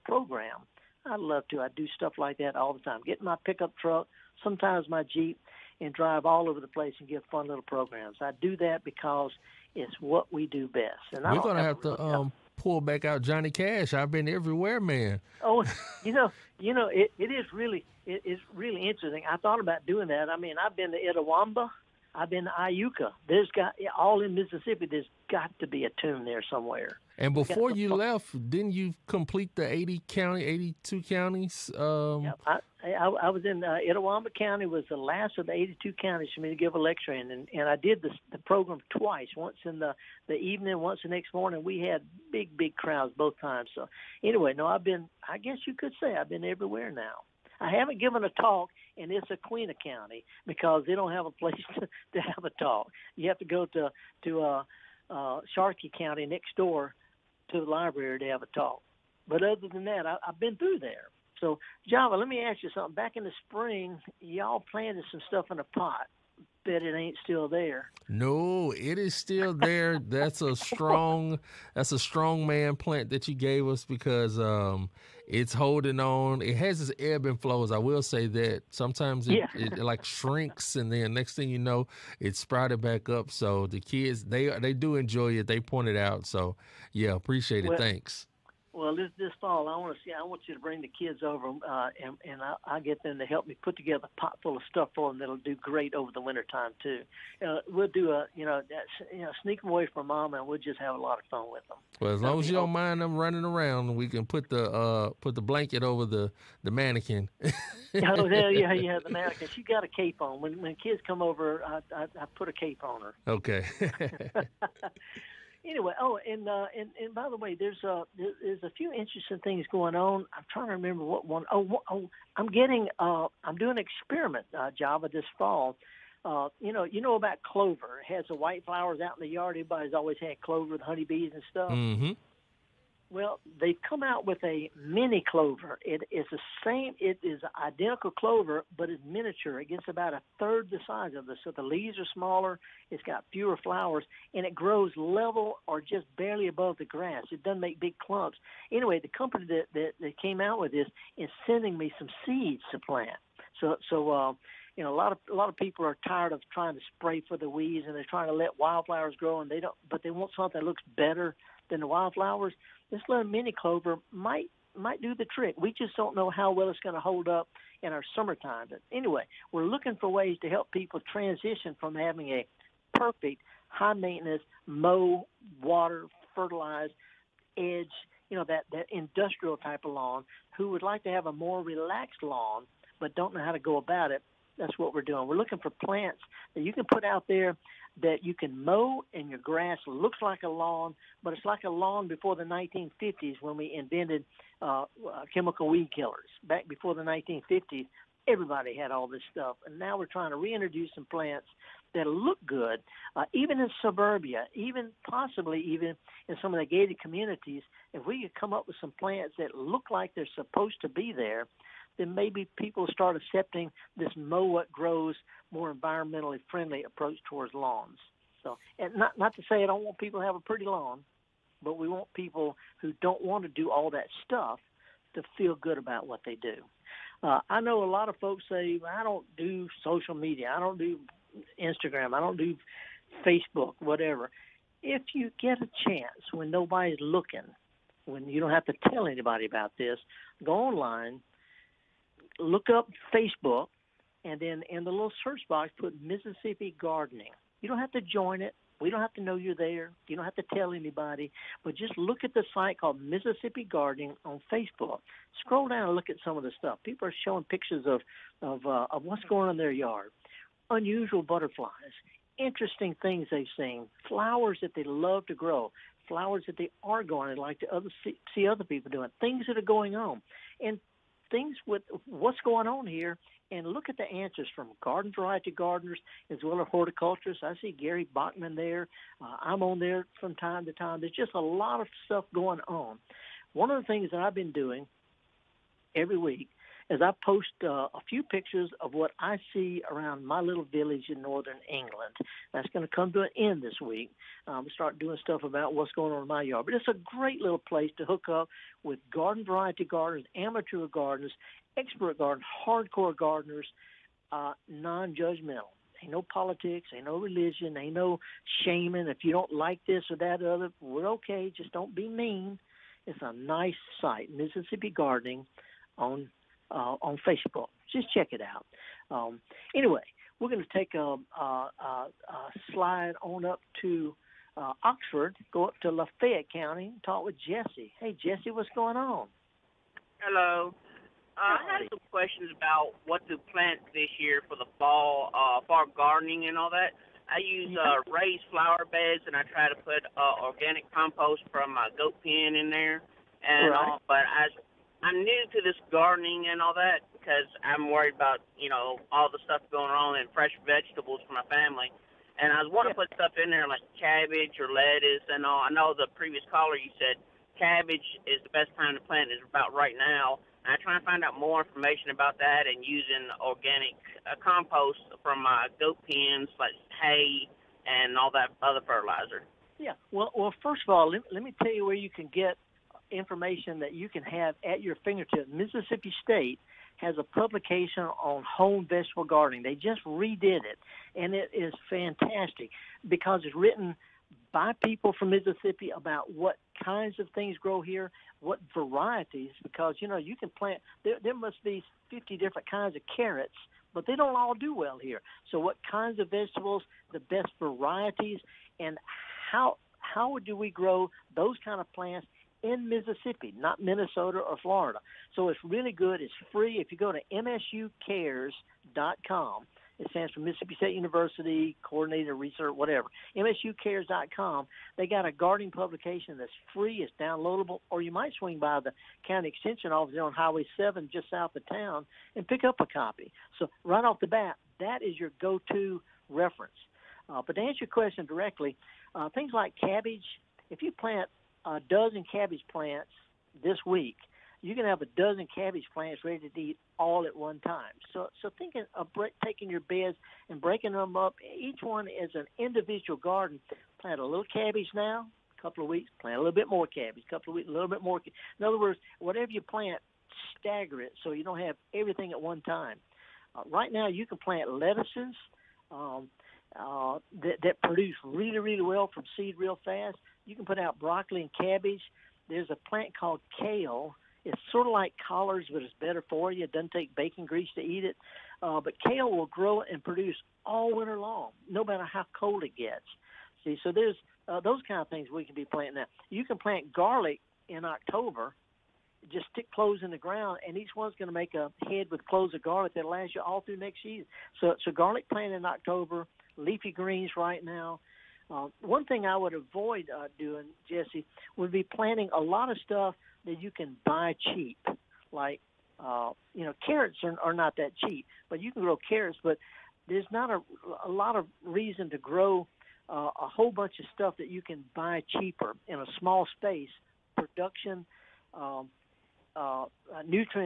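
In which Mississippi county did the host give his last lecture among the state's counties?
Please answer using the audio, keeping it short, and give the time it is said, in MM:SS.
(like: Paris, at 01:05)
Itawamba County, at 00:33.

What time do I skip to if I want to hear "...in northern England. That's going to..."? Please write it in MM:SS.
04:51.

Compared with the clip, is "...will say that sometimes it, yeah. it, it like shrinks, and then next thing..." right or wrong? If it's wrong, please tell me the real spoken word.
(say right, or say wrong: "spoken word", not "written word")
right.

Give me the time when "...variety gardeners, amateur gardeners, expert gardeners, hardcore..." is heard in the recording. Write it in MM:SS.
04:59.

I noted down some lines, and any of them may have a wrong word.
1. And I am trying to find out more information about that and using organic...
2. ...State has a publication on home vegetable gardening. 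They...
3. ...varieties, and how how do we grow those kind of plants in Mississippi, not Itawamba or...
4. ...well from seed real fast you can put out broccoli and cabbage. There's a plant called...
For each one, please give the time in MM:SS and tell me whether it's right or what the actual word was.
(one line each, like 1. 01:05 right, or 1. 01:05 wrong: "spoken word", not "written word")
1. 06:00 right
2. 06:16 right
3. 06:37 wrong: "Minnesota", not "Itawamba"
4. 07:38 right.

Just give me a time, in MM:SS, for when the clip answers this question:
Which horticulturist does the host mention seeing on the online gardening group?
04:37.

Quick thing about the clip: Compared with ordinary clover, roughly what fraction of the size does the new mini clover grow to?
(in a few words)
a third.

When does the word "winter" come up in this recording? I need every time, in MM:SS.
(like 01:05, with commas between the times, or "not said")
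01:36, 07:50.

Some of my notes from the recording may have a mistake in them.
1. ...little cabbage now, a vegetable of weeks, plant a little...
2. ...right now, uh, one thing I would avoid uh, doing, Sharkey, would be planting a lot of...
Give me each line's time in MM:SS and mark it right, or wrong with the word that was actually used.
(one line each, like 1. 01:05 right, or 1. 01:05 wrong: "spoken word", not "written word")
1. 07:24 wrong: "couple", not "vegetable"
2. 08:07 wrong: "Jesse", not "Sharkey".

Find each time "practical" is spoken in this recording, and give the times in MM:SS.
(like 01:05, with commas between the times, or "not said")
not said.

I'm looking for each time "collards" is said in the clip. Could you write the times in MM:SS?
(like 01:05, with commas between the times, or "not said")
07:45.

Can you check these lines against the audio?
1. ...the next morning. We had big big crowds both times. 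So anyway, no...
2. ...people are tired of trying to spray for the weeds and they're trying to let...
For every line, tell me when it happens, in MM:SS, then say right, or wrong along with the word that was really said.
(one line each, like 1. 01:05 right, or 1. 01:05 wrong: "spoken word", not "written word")
1. 00:41 right
2. 02:35 right.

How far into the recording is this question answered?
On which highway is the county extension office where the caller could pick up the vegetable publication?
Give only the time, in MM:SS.
07:00.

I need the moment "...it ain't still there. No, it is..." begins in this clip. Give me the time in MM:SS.
01:06.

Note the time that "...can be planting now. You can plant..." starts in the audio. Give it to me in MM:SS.
07:55.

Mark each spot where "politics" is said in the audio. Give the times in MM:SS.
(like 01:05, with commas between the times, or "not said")
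05:06.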